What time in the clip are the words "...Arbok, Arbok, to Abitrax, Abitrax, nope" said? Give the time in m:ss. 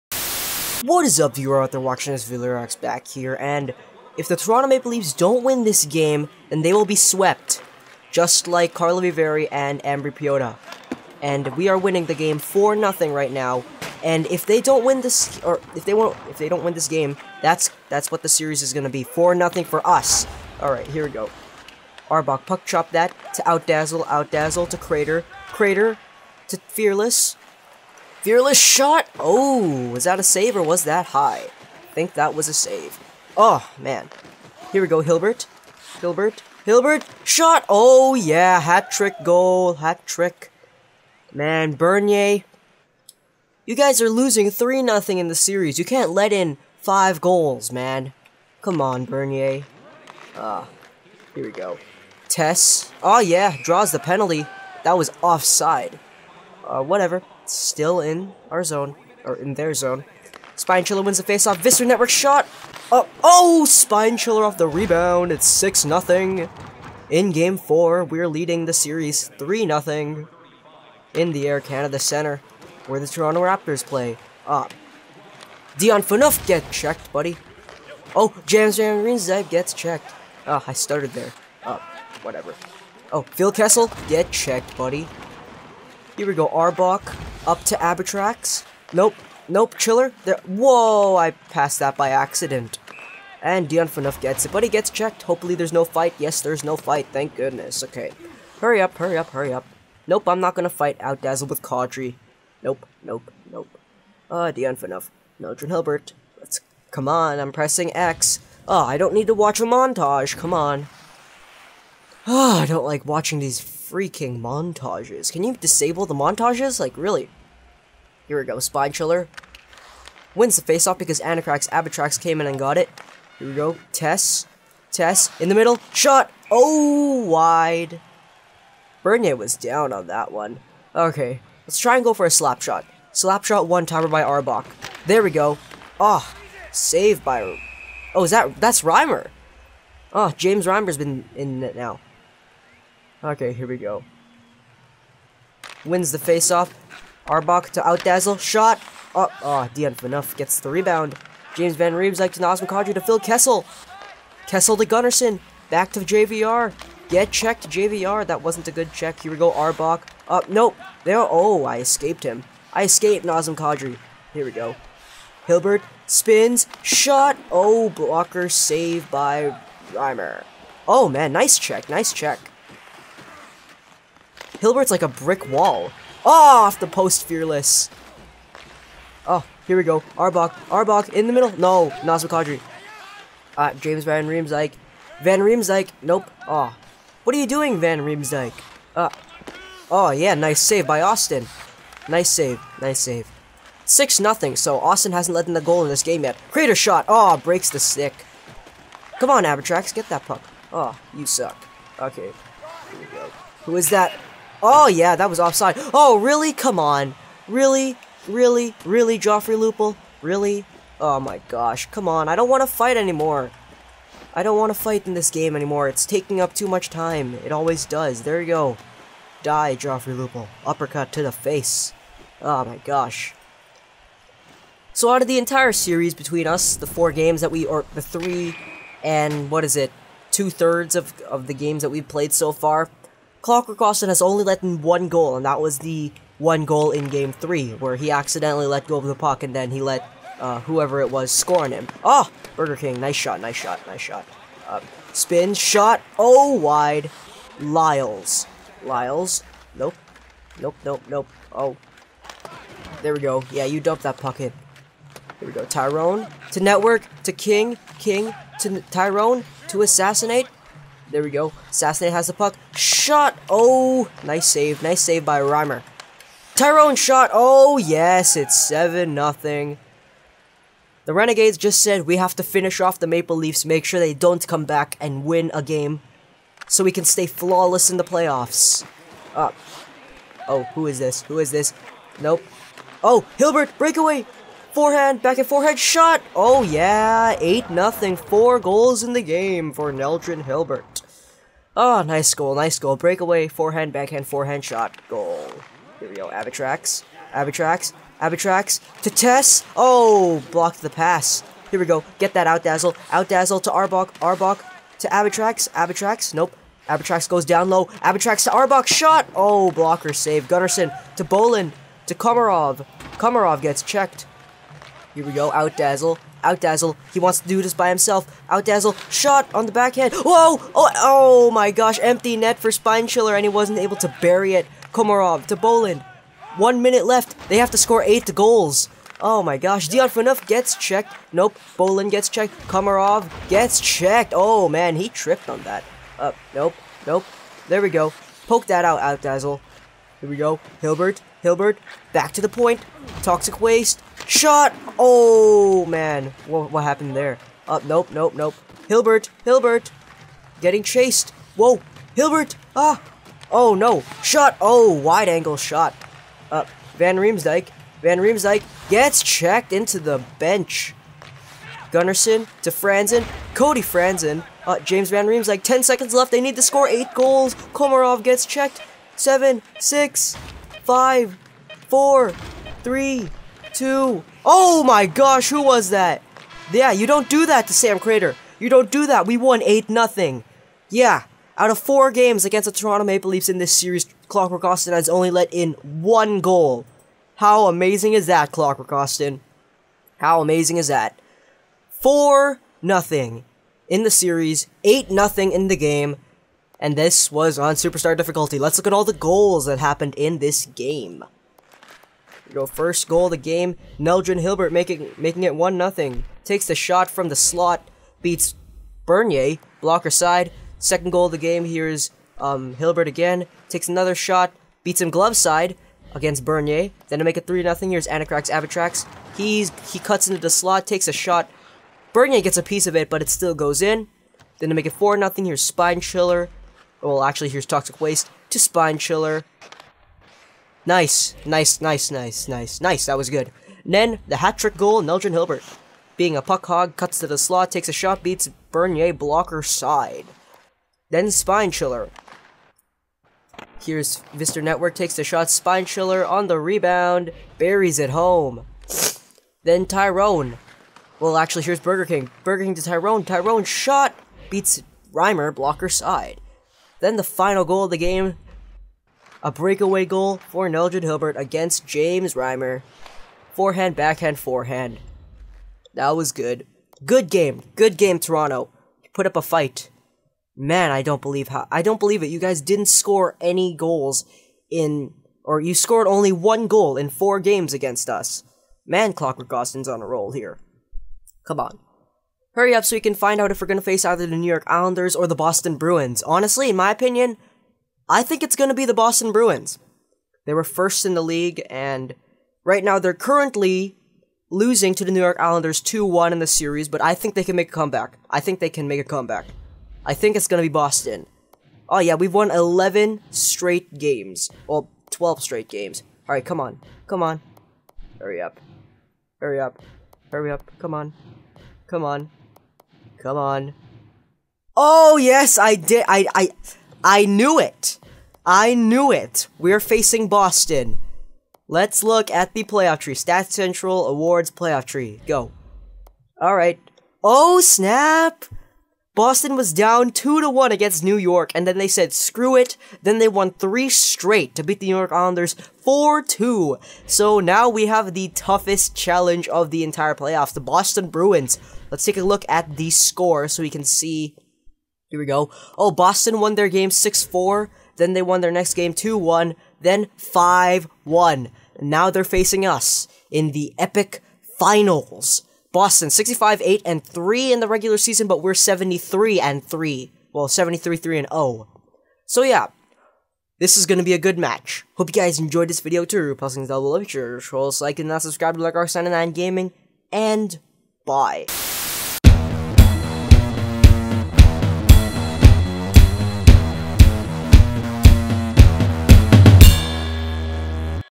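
5:03.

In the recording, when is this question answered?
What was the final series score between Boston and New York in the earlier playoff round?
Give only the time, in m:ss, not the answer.
8:55.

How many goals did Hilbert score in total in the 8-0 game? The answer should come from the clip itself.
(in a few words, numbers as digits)
4.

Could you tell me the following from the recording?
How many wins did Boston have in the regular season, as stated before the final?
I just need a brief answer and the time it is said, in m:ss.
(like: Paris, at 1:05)
65, at 9:16.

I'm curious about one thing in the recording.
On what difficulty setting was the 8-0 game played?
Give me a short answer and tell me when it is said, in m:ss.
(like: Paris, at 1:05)
Superstar, at 6:37.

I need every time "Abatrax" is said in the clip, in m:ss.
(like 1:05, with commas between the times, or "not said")
1:27, 2:01, 3:19.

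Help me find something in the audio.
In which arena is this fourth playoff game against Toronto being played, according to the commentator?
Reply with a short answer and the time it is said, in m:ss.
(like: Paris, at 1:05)
Air Canada Center, at 1:11.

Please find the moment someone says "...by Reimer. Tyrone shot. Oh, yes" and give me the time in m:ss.
4:25.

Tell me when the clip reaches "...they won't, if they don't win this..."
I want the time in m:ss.
0:15.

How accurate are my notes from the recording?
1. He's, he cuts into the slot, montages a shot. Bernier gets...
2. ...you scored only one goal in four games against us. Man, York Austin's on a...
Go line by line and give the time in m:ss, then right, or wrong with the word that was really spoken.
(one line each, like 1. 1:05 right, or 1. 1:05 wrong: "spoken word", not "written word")
1. 6:59 wrong: "takes", not "montages"
2. 7:55 wrong: "Clockwork", not "York".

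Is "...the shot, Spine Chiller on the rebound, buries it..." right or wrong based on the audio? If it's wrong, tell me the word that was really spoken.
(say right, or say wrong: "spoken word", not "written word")
right.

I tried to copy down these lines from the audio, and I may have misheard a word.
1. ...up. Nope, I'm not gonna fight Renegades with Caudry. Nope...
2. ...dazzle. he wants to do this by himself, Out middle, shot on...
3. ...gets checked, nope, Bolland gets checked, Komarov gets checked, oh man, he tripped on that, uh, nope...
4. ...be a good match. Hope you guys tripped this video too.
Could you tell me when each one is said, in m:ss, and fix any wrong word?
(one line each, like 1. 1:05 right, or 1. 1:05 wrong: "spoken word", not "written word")
1. 1:39 wrong: "Outdazzle", not "Renegades"
2. 5:16 wrong: "dazzle", not "middle"
3. 5:30 right
4. 9:24 wrong: "enjoyed", not "tripped".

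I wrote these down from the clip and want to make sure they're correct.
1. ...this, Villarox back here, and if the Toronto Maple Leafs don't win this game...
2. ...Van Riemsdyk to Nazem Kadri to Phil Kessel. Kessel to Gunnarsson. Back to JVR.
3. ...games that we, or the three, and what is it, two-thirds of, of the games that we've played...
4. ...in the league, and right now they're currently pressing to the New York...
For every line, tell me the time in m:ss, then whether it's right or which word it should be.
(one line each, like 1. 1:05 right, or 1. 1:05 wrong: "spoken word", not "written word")
1. 0:02 right
2. 2:31 right
3. 3:47 right
4. 8:11 wrong: "losing", not "pressing".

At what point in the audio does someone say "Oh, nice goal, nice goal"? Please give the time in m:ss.
4:51.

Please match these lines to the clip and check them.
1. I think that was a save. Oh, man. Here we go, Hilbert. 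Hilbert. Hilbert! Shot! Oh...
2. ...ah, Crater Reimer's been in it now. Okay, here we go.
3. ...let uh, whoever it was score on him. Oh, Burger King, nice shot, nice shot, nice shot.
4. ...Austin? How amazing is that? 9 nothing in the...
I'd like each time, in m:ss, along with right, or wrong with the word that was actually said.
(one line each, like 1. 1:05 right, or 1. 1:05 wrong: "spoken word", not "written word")
1. 0:31 right
2. 2:20 wrong: "James", not "Crater"
3. 3:59 right
4. 6:28 wrong: "4", not "9".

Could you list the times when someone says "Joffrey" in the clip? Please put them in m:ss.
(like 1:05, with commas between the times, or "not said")
3:29, 3:39.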